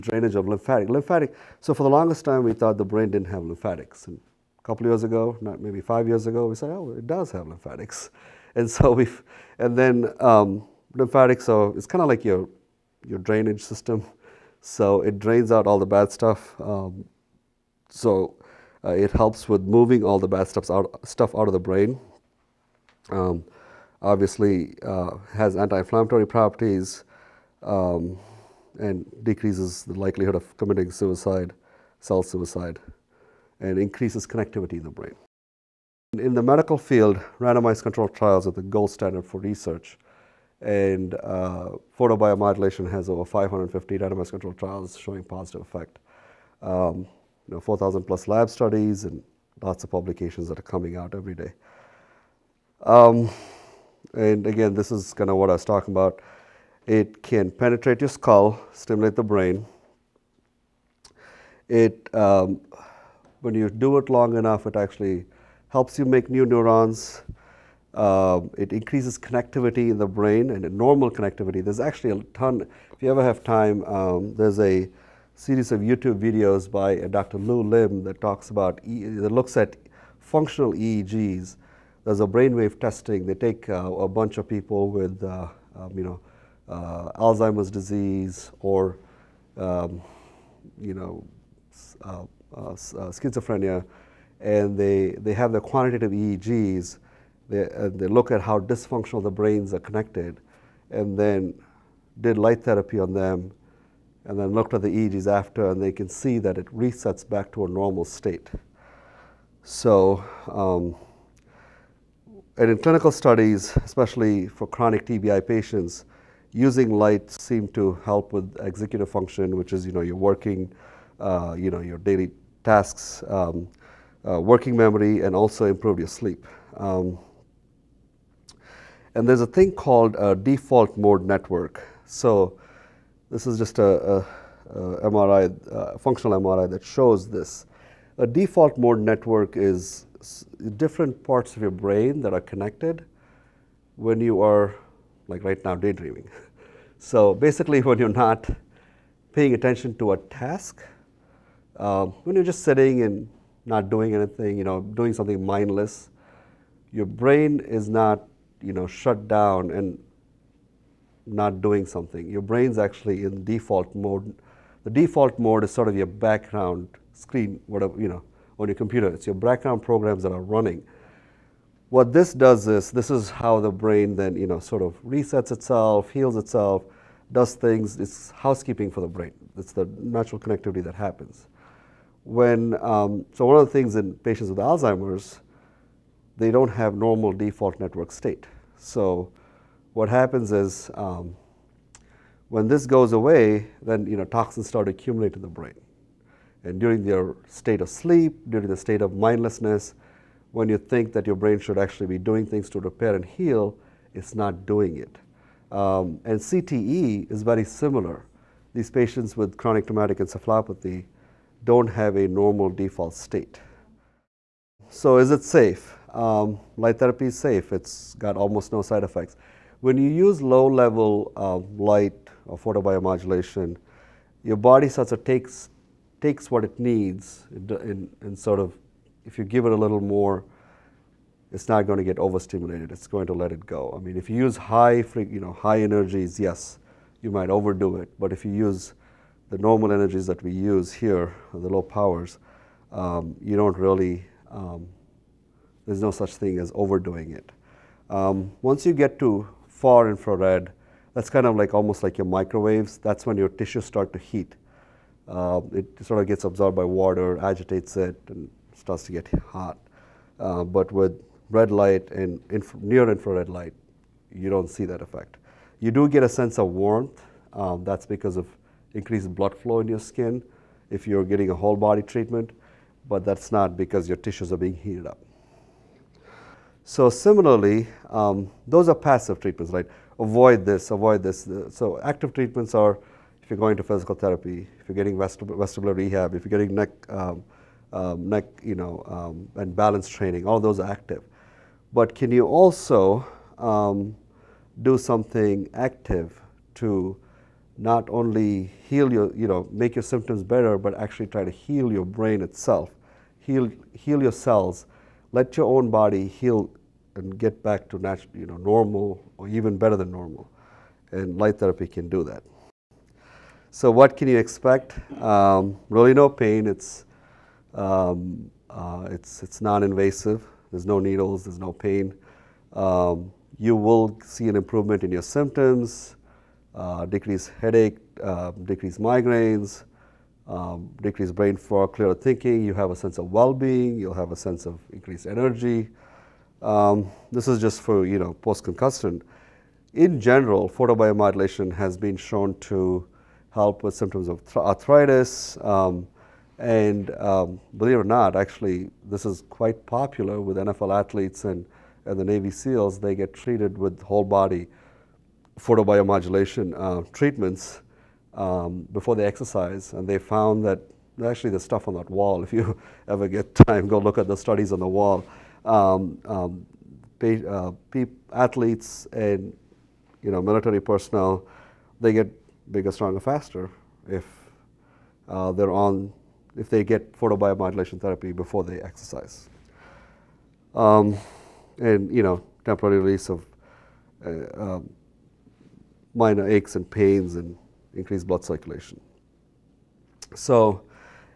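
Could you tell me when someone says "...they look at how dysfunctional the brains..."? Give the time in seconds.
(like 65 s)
97 s.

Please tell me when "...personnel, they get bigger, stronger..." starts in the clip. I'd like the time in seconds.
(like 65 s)
370 s.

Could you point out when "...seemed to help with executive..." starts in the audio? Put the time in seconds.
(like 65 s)
117 s.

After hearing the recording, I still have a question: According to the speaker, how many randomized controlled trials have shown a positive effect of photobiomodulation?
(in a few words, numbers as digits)
550.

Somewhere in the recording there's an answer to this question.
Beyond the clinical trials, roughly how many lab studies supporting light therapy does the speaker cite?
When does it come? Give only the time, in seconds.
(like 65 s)
47 s.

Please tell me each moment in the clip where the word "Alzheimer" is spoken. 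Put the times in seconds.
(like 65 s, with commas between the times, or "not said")
87 s, 184 s.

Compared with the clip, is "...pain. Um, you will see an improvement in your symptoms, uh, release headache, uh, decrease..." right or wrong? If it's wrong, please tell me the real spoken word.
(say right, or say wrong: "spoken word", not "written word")
wrong: "decrease", not "release".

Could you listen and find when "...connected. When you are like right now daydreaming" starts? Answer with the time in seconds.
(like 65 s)
142 s.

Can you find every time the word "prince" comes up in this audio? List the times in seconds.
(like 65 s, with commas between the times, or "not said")
not said.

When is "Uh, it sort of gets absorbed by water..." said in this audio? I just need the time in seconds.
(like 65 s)
255 s.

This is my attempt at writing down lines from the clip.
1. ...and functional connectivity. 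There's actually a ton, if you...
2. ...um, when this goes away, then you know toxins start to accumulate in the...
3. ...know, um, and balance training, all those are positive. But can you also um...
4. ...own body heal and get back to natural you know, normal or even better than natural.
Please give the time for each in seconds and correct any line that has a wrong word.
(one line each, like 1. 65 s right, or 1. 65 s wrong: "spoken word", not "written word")
1. 70 s wrong: "normal", not "functional"
2. 190 s right
3. 288 s wrong: "active", not "positive"
4. 305 s wrong: "normal", not "natural".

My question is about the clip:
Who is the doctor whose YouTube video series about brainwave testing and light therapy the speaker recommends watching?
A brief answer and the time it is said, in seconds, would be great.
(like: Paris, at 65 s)
Dr. Lew Lim, at 77 s.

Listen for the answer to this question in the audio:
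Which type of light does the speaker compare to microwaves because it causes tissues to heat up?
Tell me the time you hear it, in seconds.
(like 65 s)
249 s.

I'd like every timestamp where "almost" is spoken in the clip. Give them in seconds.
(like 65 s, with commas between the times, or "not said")
218 s, 251 s.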